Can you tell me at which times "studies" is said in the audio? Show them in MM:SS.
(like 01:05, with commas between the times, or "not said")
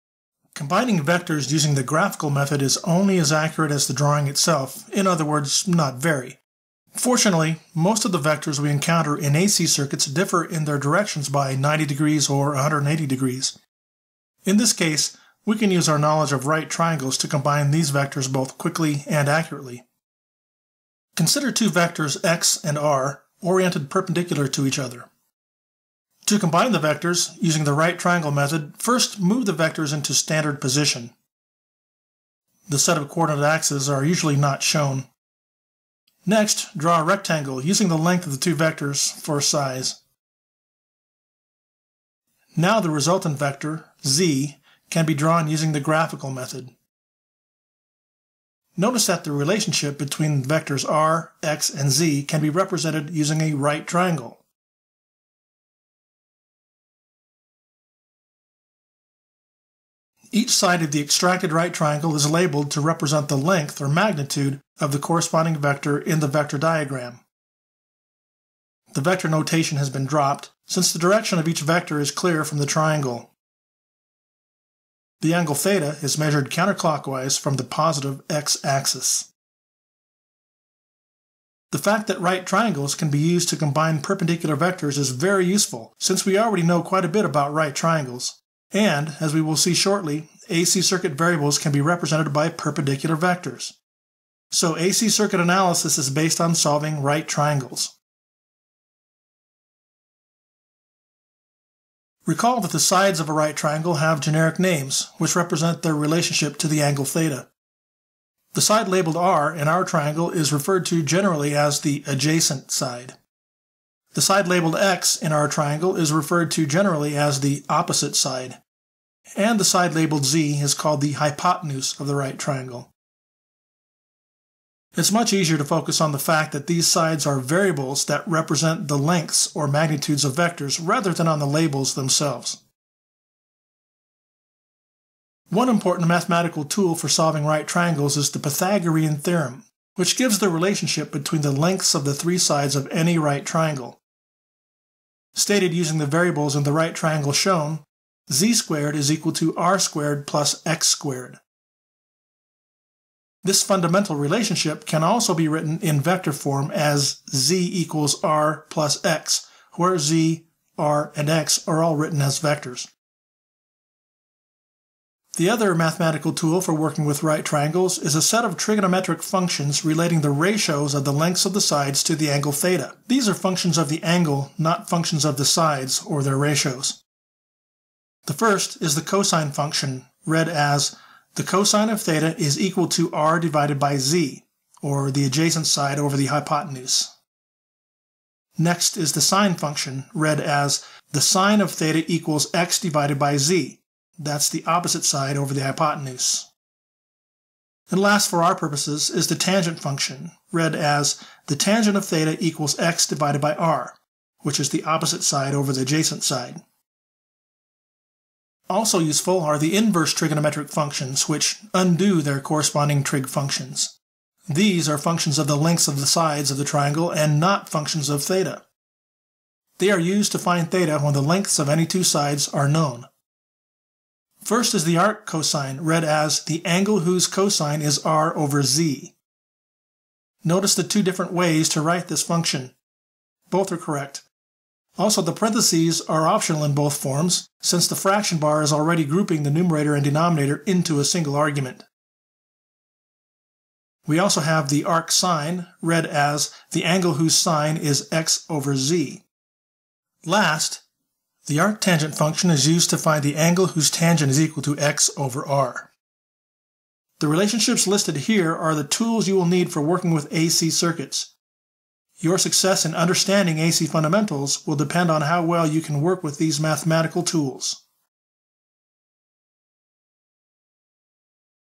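not said.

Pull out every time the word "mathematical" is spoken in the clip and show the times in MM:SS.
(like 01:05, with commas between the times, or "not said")
02:16, 02:45, 04:26.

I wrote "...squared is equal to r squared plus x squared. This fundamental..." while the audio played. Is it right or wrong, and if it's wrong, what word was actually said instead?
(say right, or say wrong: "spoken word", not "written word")
right.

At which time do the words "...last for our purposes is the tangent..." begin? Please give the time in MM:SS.
03:17.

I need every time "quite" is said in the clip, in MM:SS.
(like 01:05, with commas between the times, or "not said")
01:26.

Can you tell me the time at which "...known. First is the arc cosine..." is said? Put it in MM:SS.
03:42.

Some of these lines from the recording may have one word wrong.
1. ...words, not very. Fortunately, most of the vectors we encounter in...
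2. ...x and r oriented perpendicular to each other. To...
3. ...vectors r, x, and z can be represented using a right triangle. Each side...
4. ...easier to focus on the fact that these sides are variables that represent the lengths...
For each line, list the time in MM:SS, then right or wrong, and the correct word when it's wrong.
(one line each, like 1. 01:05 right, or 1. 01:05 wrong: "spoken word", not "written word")
1. 00:05 right
2. 00:22 right
3. 00:50 right
4. 02:05 right.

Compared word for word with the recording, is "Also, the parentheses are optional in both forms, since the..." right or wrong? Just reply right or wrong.
right.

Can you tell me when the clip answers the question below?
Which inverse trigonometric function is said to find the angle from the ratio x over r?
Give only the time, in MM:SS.
04:11.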